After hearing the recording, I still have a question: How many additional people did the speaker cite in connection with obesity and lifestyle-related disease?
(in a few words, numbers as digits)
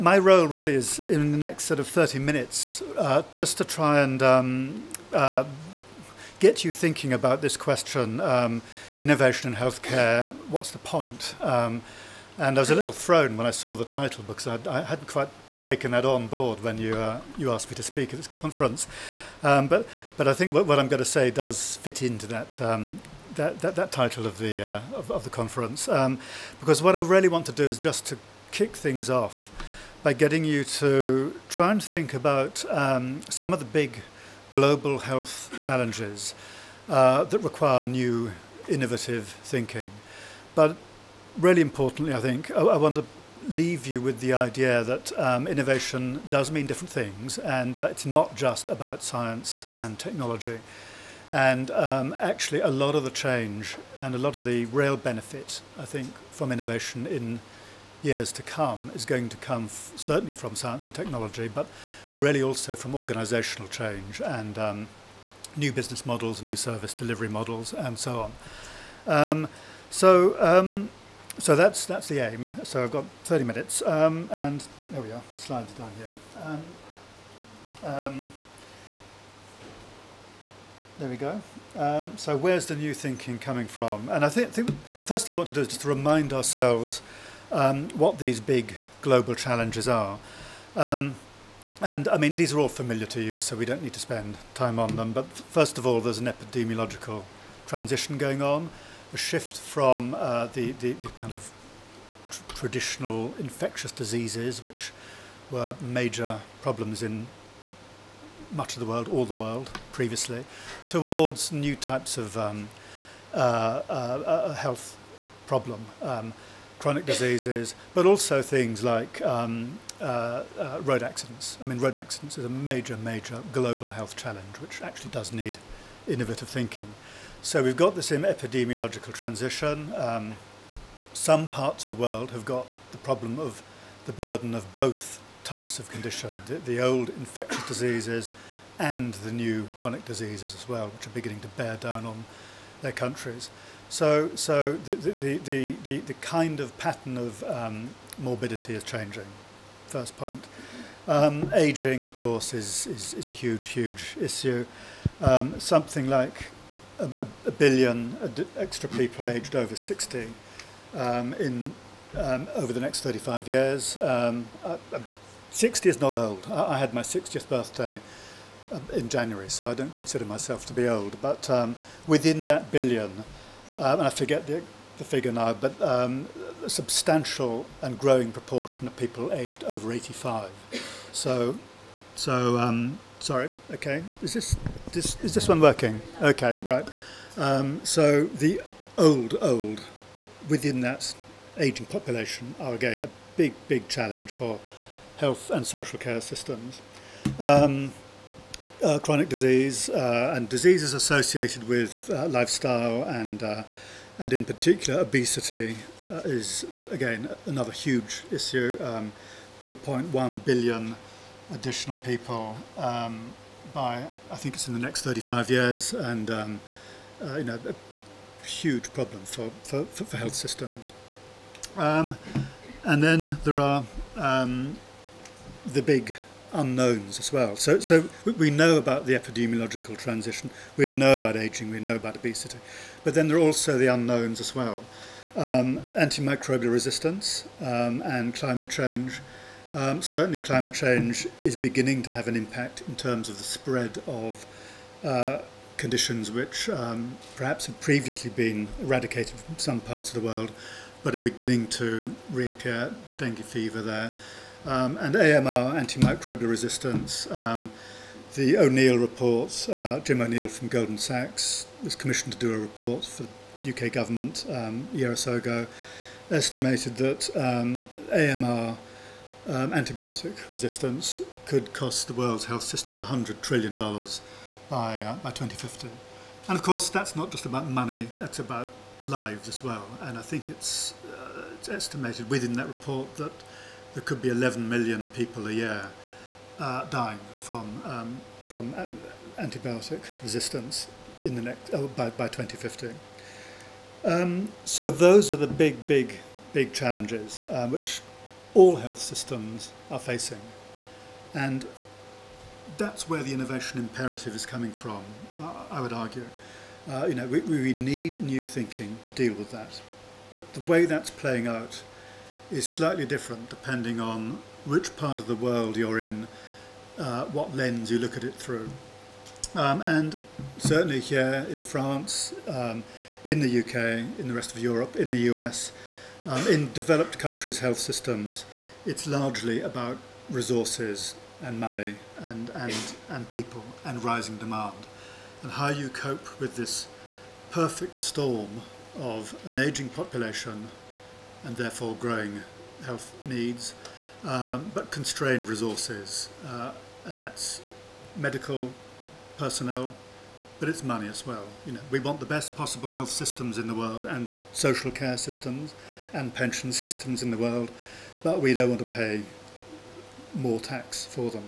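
2.1 billion.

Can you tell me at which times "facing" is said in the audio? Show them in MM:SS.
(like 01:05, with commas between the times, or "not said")
04:59.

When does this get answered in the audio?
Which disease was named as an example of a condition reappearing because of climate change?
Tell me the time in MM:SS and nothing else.
04:13.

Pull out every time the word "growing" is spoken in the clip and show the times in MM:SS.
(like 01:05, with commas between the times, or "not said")
02:57, 05:41.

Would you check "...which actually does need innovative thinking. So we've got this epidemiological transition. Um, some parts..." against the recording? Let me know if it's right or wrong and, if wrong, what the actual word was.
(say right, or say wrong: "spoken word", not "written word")
right.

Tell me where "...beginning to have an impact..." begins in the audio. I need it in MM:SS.
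04:01.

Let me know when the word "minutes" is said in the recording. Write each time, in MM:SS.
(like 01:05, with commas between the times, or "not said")
00:02, 01:13.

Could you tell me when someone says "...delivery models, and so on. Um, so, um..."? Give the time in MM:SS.
01:06.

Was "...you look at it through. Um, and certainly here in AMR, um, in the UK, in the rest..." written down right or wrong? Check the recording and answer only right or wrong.
wrong.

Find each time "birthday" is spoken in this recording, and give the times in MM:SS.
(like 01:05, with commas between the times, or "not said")
02:47.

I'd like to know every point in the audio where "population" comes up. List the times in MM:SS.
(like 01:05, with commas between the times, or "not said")
03:11, 05:39.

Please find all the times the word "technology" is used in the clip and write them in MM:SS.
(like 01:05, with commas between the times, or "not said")
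00:49, 01:00.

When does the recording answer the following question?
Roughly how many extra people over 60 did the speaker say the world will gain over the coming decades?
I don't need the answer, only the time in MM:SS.
02:37.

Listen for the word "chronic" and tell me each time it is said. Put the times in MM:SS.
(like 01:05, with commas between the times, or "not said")
01:56, 02:19, 03:18.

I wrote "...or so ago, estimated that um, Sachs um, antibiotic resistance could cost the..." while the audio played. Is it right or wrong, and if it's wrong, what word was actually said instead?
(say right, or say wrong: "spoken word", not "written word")
wrong: "AMR", not "Sachs".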